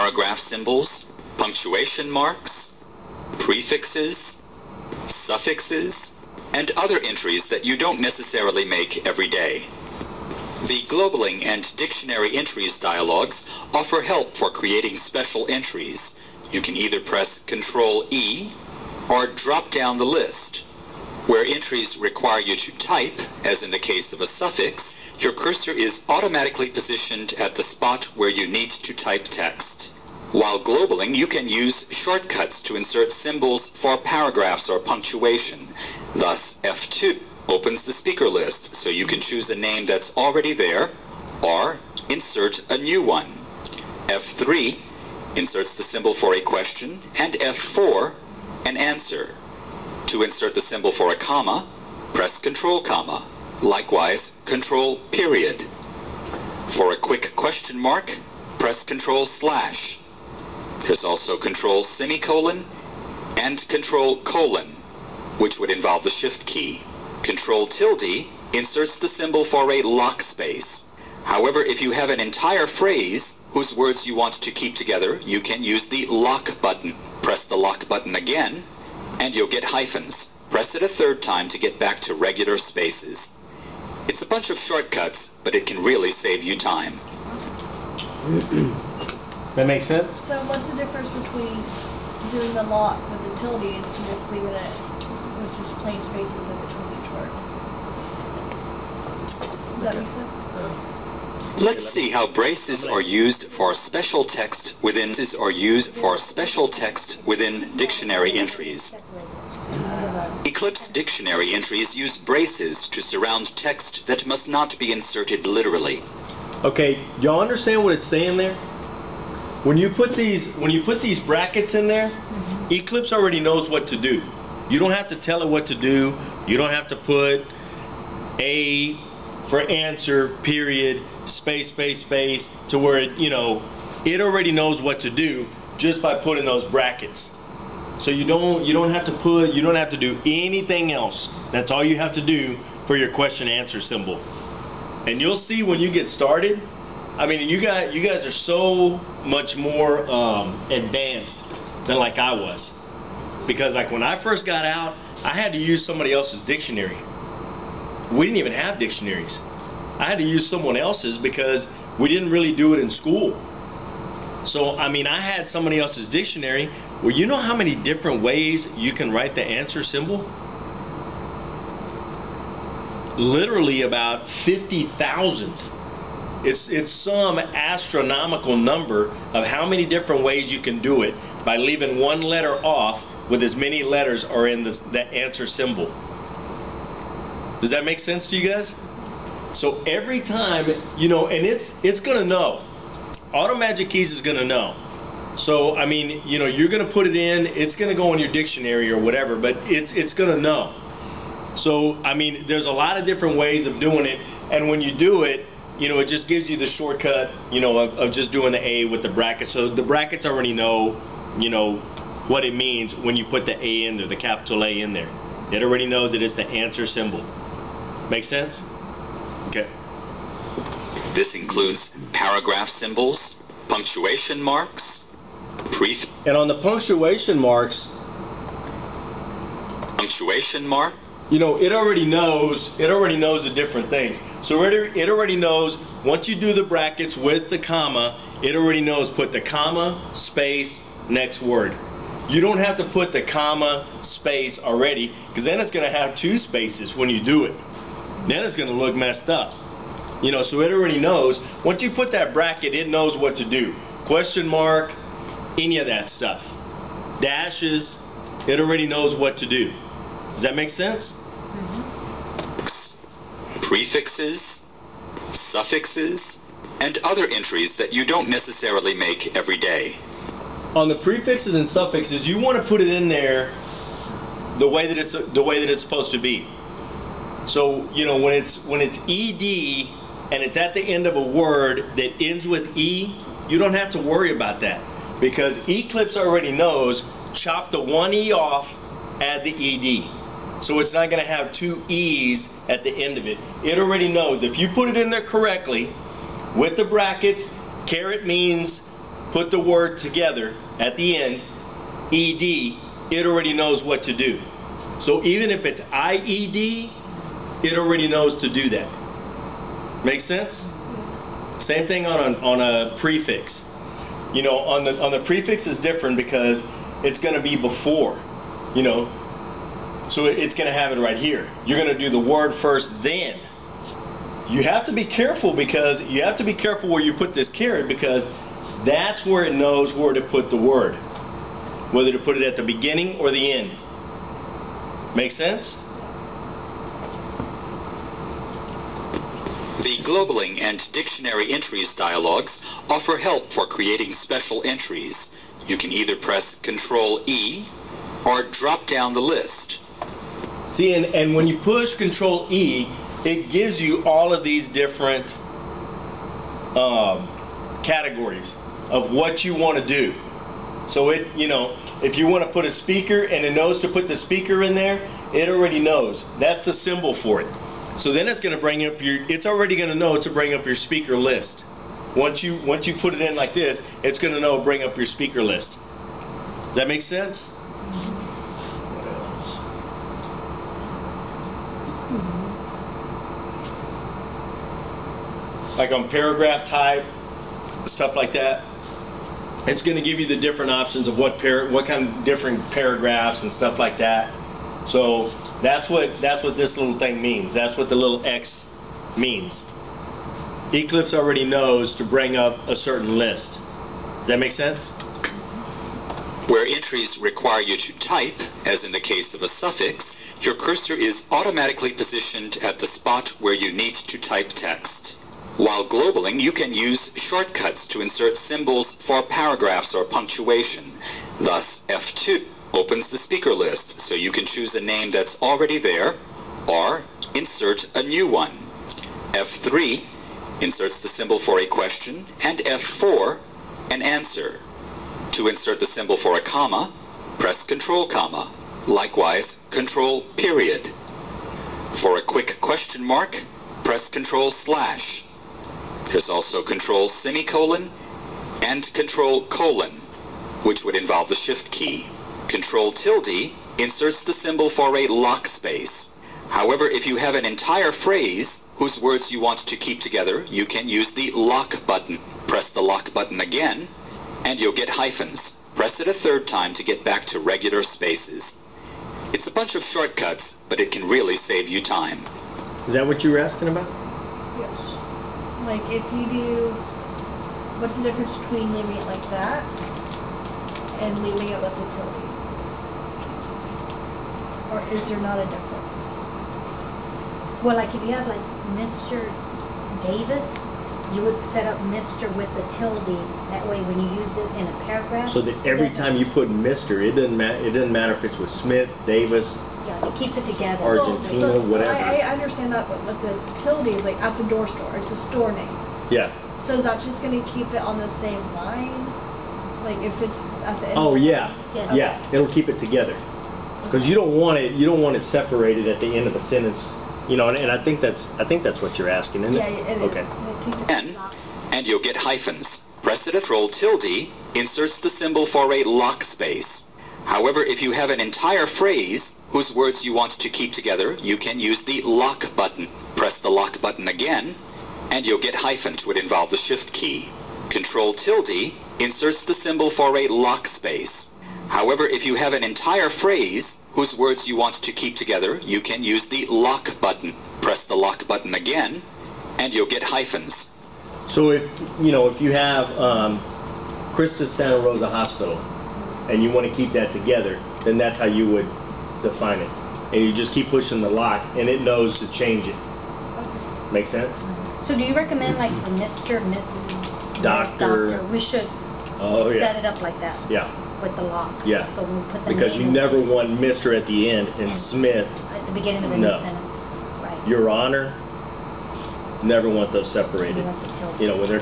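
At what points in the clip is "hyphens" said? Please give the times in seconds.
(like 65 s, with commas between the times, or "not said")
79 s, 464 s, 522 s, 535 s, 550 s.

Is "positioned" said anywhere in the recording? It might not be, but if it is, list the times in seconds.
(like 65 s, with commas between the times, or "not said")
26 s, 411 s.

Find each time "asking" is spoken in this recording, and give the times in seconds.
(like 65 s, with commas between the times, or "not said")
473 s, 519 s.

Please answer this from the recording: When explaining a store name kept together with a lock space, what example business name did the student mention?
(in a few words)
The Door Store.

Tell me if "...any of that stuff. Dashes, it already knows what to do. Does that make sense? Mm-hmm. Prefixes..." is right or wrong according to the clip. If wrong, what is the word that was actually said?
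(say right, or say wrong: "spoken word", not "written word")
right.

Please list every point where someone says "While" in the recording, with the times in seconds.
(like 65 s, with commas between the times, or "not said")
30 s, 415 s.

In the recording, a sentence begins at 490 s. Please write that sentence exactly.
Davis, you would set up Mr.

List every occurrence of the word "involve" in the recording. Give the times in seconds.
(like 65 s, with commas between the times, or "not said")
65 s, 450 s, 536 s.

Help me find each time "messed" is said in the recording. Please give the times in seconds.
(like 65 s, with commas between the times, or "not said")
248 s.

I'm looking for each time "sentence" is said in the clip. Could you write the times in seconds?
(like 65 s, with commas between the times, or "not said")
516 s, 576 s.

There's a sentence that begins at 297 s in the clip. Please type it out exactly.
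Caret means put the word together at the end.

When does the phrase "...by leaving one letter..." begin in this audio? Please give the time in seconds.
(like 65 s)
181 s.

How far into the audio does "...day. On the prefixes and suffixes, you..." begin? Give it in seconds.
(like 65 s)
269 s.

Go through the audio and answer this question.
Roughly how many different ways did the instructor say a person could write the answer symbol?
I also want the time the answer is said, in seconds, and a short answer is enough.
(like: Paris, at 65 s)
50,000, at 173 s.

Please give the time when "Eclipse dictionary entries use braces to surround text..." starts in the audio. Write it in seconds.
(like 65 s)
110 s.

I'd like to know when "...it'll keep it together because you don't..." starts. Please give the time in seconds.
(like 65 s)
512 s.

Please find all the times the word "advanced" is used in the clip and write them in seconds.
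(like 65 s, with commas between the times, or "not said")
150 s.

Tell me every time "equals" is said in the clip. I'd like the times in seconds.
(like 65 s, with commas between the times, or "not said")
not said.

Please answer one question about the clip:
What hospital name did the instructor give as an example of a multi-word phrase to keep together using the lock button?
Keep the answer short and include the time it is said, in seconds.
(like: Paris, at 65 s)
Christus Santa Rosa Hospital, at 554 s.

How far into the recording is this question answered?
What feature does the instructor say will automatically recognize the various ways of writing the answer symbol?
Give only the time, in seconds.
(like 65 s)
193 s.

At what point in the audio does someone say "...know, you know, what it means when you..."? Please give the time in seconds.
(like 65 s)
210 s.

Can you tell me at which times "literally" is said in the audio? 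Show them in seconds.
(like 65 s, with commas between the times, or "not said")
115 s, 173 s.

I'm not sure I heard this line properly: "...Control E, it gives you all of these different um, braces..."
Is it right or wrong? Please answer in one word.
wrong.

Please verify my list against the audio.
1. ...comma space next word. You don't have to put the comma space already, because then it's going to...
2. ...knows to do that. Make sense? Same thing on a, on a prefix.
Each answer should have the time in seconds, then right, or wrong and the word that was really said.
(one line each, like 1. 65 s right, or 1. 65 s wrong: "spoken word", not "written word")
1. 239 s right
2. 308 s right.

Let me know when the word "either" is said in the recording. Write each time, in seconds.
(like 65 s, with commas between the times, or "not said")
16 s, 345 s.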